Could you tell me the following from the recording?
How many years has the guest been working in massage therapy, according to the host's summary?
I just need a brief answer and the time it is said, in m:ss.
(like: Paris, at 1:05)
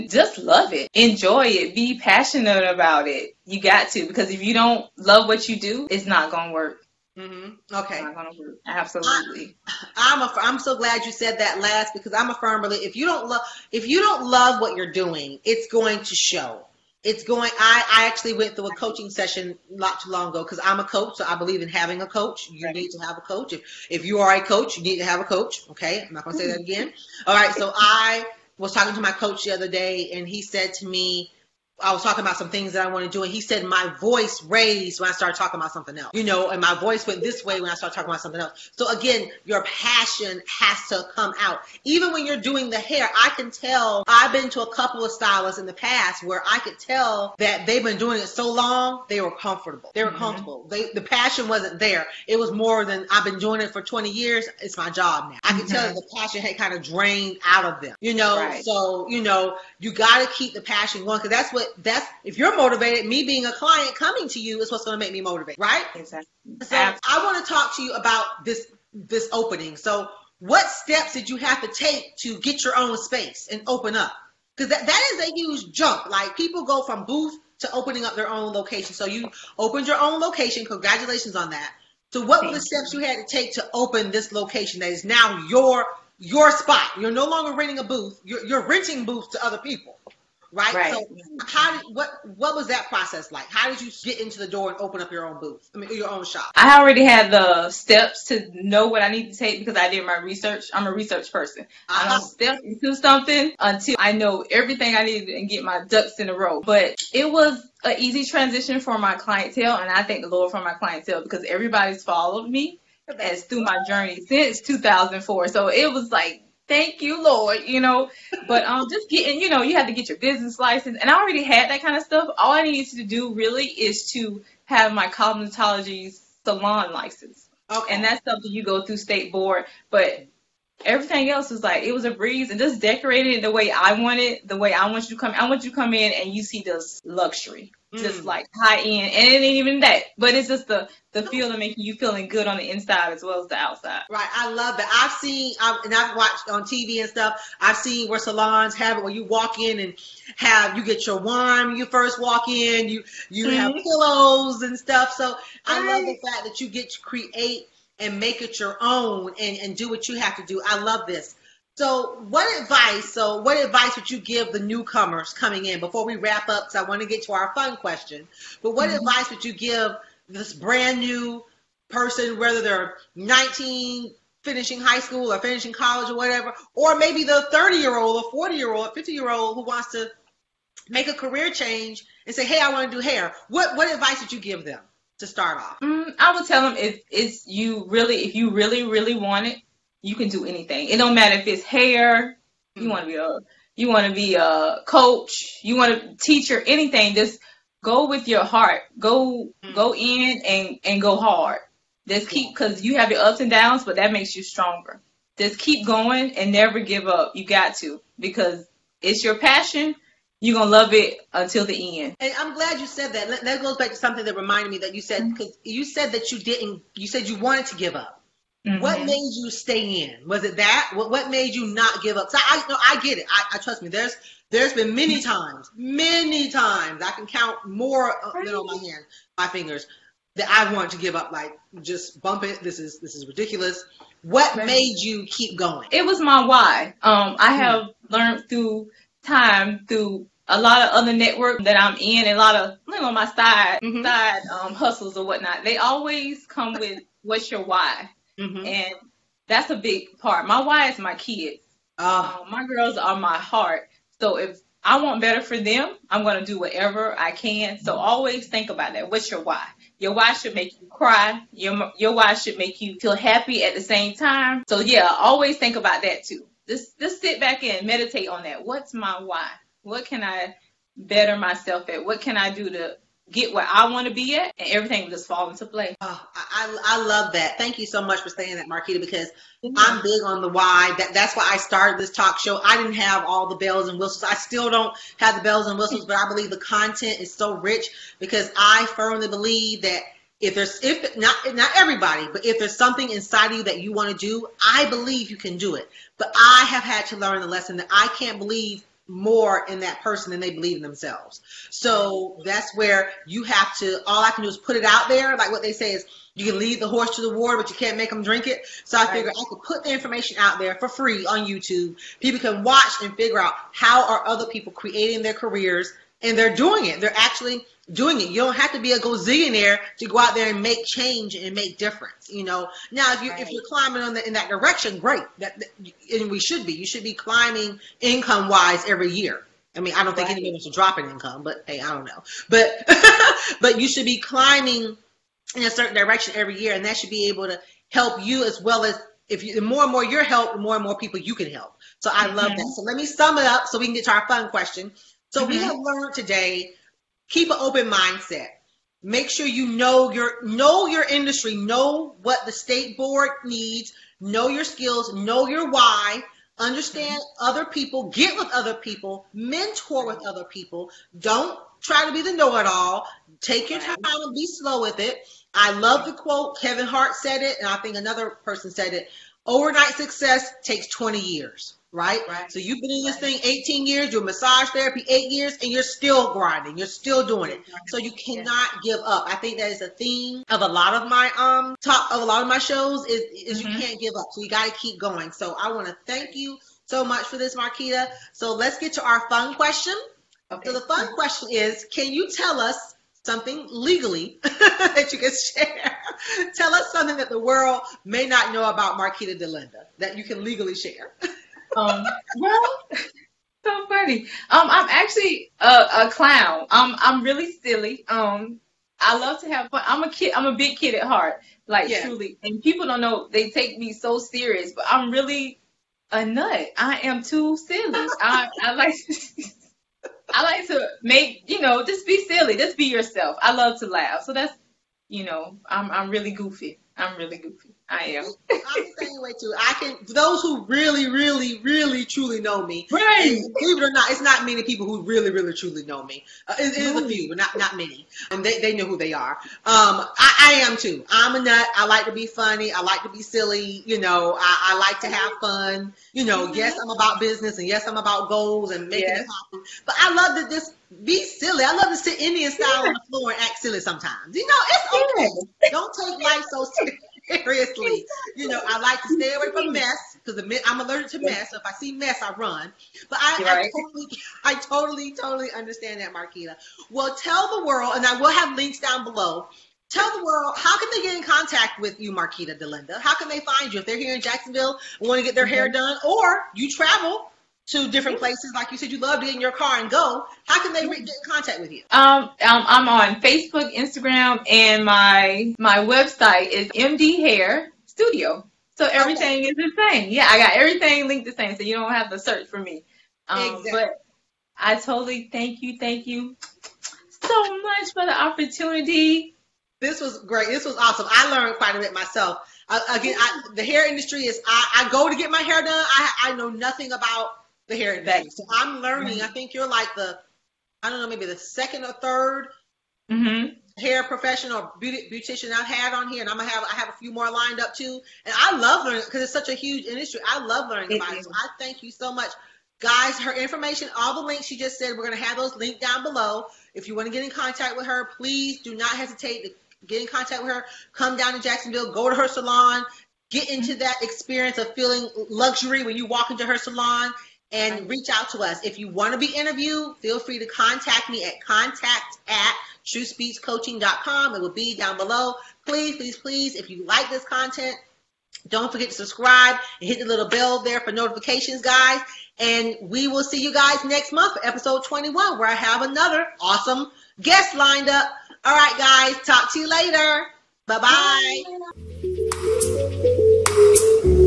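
8, at 6:15.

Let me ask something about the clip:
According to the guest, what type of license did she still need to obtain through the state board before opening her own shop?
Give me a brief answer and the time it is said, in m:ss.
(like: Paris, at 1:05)
cosmetology salon license, at 2:05.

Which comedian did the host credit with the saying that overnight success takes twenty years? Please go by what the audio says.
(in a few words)
Kevin Hart.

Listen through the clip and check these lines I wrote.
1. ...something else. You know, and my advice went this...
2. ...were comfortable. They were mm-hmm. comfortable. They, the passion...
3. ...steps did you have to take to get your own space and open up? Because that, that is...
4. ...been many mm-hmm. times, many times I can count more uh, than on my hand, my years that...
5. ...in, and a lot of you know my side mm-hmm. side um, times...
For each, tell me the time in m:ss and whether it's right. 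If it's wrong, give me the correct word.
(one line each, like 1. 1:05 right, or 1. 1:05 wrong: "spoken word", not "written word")
1. 0:35 wrong: "voice", not "advice"
2. 0:49 right
3. 1:10 right
4. 3:44 wrong: "fingers", not "years"
5. 4:01 wrong: "hustles", not "times".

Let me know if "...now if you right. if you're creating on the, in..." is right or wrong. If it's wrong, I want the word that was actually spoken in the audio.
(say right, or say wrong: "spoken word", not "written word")
wrong: "climbing", not "creating".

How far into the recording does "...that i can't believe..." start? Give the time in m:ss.
4:57.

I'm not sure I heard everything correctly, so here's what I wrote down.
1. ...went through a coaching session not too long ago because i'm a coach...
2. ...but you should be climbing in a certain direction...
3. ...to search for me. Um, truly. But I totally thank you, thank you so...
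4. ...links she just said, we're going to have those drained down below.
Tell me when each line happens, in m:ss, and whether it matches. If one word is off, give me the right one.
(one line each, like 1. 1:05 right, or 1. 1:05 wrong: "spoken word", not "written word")
1. 0:18 right
2. 5:33 right
3. 8:12 wrong: "exactly", not "truly"
4. 8:44 wrong: "linked", not "drained".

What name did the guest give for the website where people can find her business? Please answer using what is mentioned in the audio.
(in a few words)
MD Hair Studio.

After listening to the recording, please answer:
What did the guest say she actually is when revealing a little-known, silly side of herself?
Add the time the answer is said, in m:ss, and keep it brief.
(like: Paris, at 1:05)
a clown, at 6:45.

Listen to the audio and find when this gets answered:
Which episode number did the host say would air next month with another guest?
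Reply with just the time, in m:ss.
9:14.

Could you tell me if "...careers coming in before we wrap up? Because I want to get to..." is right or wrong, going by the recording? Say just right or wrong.
wrong.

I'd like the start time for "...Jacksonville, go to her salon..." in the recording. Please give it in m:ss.
8:51.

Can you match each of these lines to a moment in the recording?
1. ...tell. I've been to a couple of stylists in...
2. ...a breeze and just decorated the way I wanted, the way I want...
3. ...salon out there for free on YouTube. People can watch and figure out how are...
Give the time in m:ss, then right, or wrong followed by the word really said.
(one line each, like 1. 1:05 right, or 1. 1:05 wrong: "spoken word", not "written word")
1. 0:43 right
2. 2:12 right
3. 5:09 wrong: "information", not "salon".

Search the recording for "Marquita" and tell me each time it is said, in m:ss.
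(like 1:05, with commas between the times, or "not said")
4:38, 6:27, 6:38, 7:46, 7:52.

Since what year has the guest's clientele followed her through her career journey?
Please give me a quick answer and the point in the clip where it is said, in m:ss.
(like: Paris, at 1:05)
2004, at 1:54.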